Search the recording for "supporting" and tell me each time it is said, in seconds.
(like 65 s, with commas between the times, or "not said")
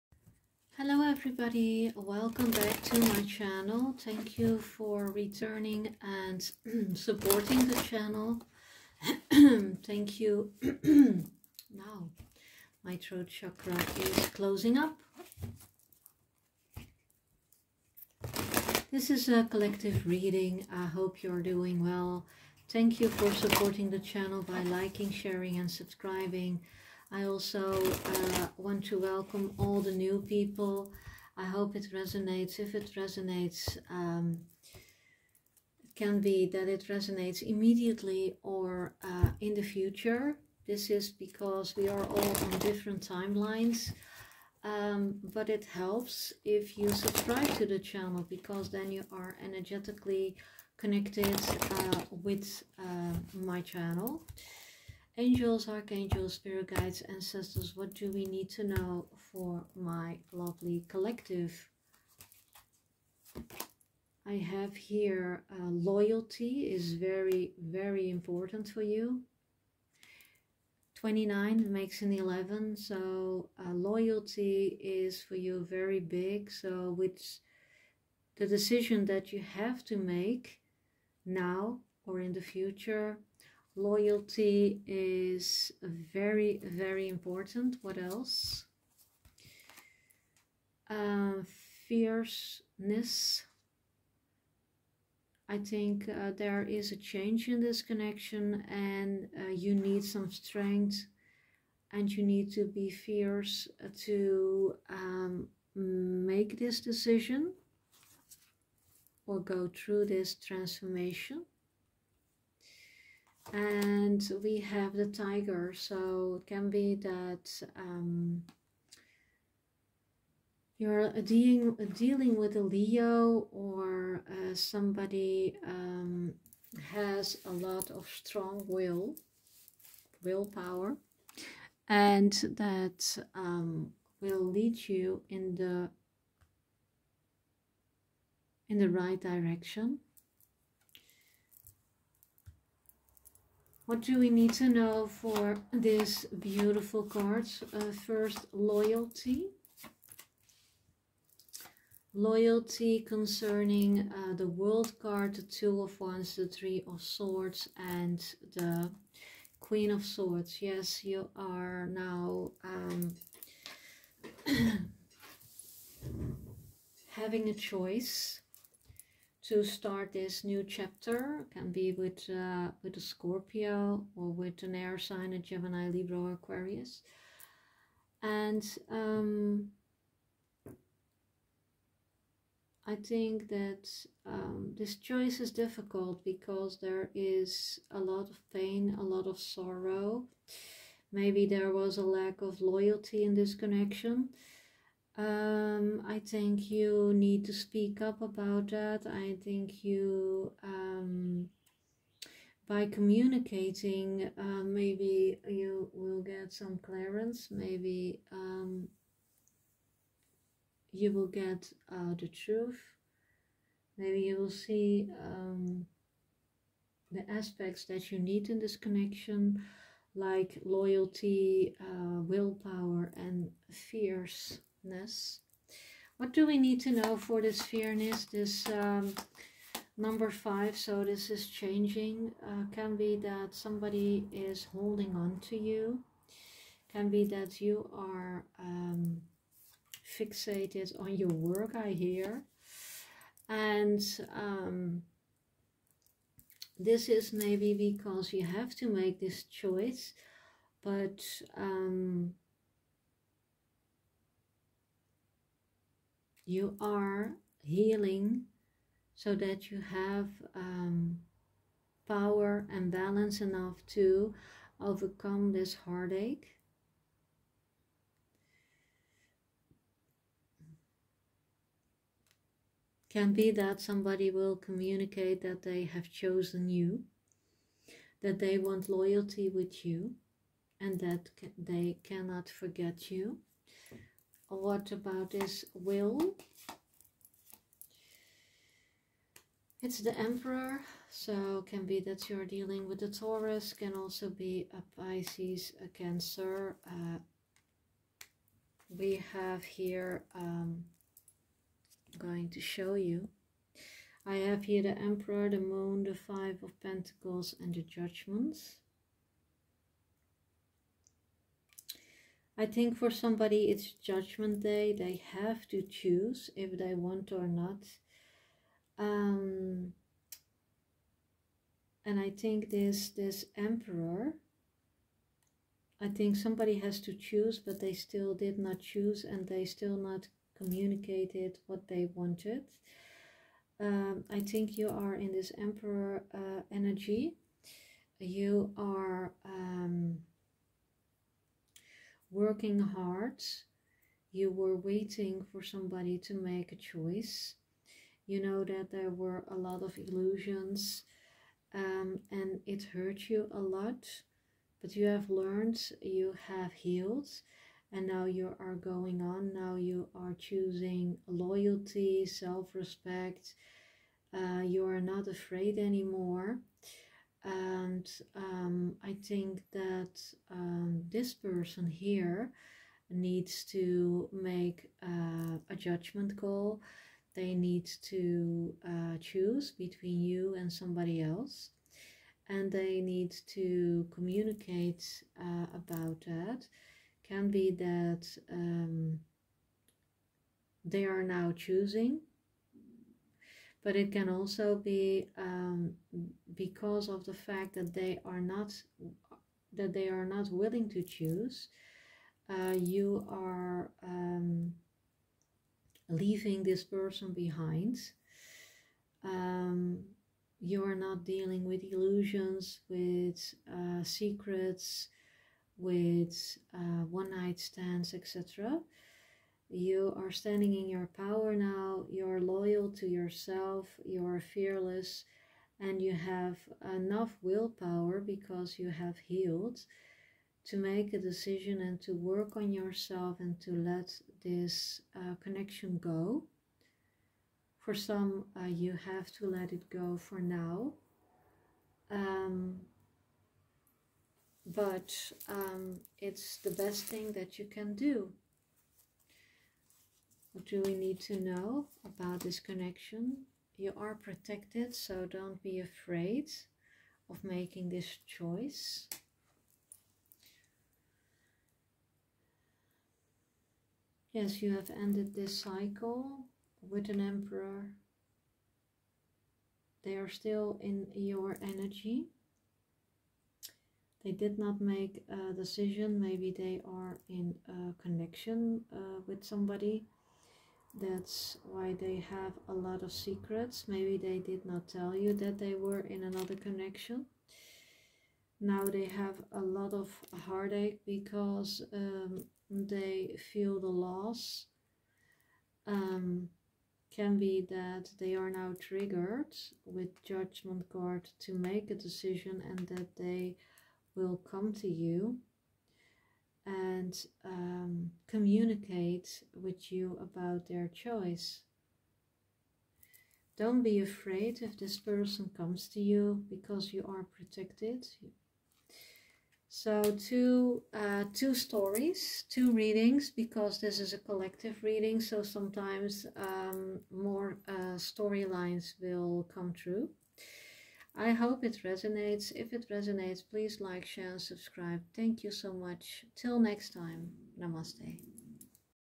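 6 s, 23 s.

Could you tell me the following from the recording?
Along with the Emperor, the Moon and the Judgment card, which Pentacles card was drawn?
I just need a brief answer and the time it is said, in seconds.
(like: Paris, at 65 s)
Five of Pentacles, at 306 s.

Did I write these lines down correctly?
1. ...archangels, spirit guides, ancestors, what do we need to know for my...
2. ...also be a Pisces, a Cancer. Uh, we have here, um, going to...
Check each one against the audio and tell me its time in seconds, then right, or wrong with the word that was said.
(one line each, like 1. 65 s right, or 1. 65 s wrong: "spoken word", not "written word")
1. 55 s right
2. 293 s right.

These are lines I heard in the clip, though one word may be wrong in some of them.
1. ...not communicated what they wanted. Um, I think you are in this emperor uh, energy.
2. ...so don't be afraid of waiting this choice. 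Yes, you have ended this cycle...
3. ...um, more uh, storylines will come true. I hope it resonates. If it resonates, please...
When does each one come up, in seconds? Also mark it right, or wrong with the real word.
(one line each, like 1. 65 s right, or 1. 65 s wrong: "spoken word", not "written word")
1. 329 s right
2. 454 s wrong: "making", not "waiting"
3. 526 s right.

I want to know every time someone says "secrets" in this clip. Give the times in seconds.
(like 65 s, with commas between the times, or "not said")
414 s, 483 s.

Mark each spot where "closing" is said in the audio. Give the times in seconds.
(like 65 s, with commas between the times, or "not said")
14 s.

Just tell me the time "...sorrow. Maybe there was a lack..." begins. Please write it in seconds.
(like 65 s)
189 s.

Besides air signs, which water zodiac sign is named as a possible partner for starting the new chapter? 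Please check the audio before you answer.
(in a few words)
Scorpio.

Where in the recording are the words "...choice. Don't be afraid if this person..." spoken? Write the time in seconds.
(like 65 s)
510 s.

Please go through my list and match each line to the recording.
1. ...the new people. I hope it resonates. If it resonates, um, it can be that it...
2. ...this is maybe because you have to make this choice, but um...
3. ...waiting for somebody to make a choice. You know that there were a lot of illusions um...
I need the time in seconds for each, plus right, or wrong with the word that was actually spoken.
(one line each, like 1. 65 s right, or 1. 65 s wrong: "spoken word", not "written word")
1. 29 s right
2. 246 s right
3. 344 s right.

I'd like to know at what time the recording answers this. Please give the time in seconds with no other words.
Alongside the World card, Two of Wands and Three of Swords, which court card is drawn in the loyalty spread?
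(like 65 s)
159 s.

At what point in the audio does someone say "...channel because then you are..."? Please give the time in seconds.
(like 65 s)
47 s.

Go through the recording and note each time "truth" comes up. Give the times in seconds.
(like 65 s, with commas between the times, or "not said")
212 s.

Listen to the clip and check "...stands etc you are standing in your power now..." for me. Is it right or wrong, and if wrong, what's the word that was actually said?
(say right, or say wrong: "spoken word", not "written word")
right.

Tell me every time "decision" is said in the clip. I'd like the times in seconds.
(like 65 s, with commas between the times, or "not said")
78 s, 106 s, 431 s, 475 s, 501 s.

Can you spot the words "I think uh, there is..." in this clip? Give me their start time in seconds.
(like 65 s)
95 s.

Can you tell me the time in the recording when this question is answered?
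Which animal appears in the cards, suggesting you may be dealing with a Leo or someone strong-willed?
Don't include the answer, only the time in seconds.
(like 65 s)
115 s.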